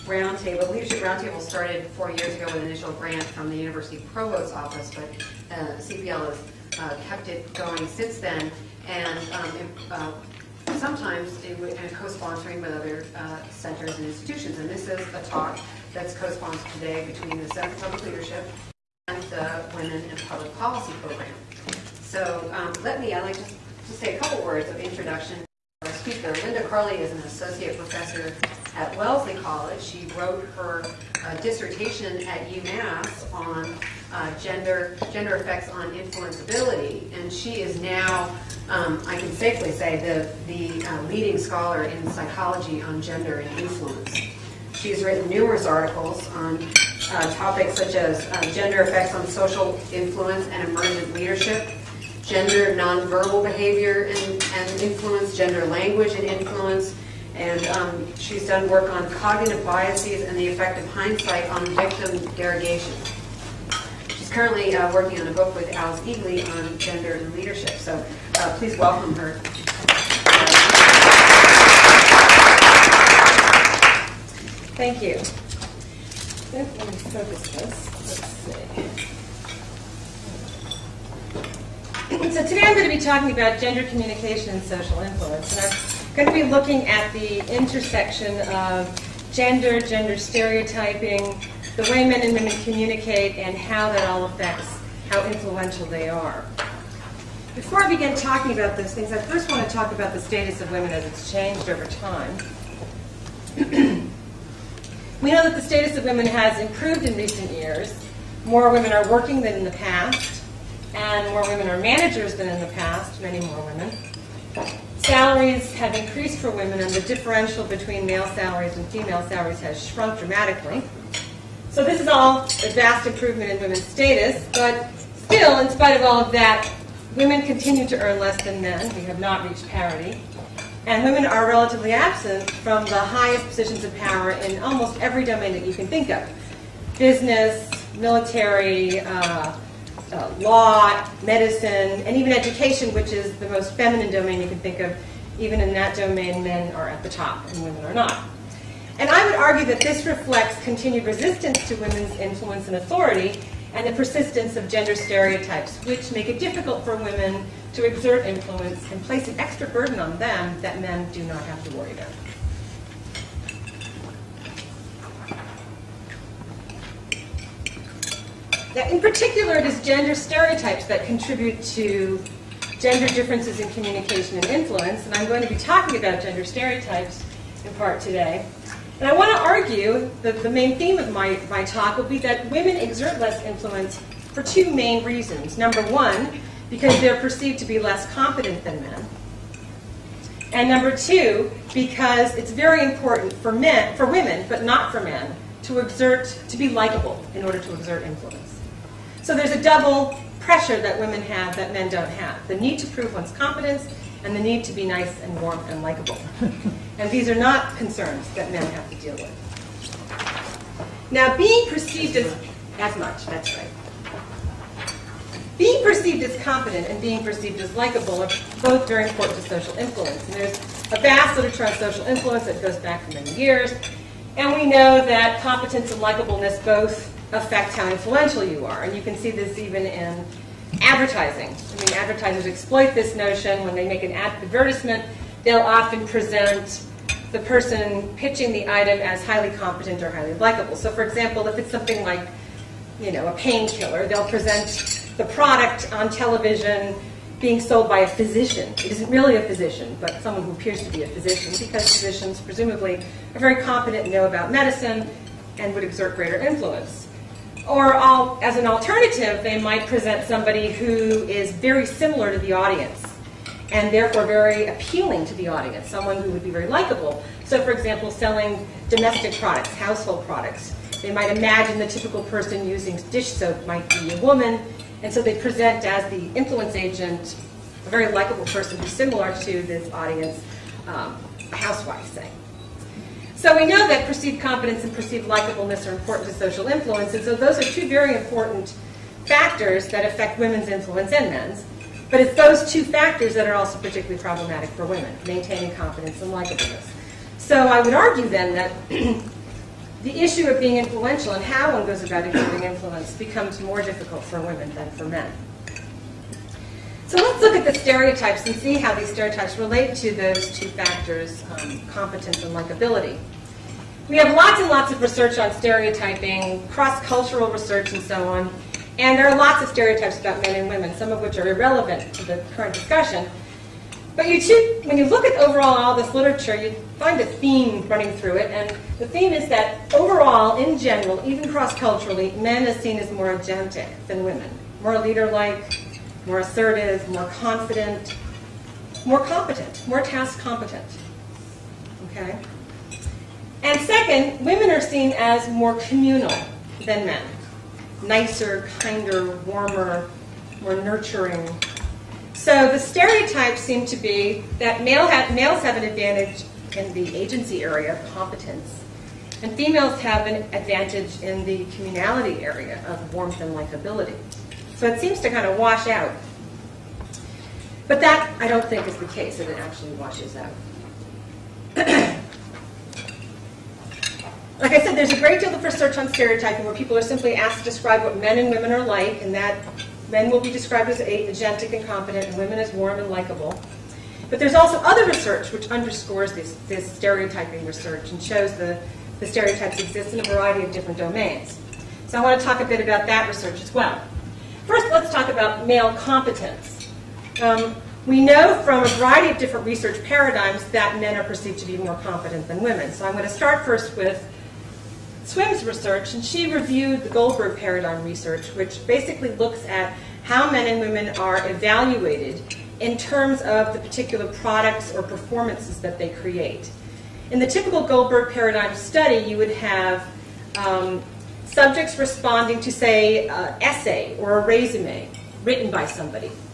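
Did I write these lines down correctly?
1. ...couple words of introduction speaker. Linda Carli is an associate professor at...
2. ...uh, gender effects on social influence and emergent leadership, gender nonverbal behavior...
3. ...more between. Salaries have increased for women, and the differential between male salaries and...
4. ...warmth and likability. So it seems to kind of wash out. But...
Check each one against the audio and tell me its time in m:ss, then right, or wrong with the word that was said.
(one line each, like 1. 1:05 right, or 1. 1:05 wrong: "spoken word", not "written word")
1. 0:24 right
2. 0:48 right
3. 1:53 wrong: "women", not "between"
4. 6:03 right.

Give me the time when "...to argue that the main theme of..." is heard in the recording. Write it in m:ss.
2:59.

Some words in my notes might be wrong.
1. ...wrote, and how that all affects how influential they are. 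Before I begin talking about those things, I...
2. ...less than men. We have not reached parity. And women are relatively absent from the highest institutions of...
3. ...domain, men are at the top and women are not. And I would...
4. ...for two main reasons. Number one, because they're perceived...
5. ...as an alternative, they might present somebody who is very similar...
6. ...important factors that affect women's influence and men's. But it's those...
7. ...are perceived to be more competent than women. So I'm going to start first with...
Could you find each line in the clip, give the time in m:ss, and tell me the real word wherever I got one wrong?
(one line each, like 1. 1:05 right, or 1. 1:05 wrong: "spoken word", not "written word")
1. 1:32 wrong: "communicate", not "wrote"
2. 2:08 wrong: "positions", not "institutions"
3. 2:25 right
4. 3:04 right
5. 4:18 right
6. 4:48 right
7. 6:41 right.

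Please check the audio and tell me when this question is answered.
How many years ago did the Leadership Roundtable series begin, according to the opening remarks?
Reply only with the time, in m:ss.
0:01.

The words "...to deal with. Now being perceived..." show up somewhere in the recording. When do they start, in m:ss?
3:28.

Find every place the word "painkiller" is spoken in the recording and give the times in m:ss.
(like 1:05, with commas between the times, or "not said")
4:03.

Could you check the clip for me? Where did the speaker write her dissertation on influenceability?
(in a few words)
UMass.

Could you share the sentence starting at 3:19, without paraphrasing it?
So there's a double pressure that women have that men don't have.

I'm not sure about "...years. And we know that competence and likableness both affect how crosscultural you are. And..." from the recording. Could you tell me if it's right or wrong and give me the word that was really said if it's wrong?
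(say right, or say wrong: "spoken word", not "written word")
wrong: "influential", not "crosscultural".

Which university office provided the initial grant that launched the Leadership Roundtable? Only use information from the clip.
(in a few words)
University Provost's office.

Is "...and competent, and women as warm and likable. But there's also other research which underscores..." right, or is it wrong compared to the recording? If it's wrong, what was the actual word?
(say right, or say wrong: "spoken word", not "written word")
right.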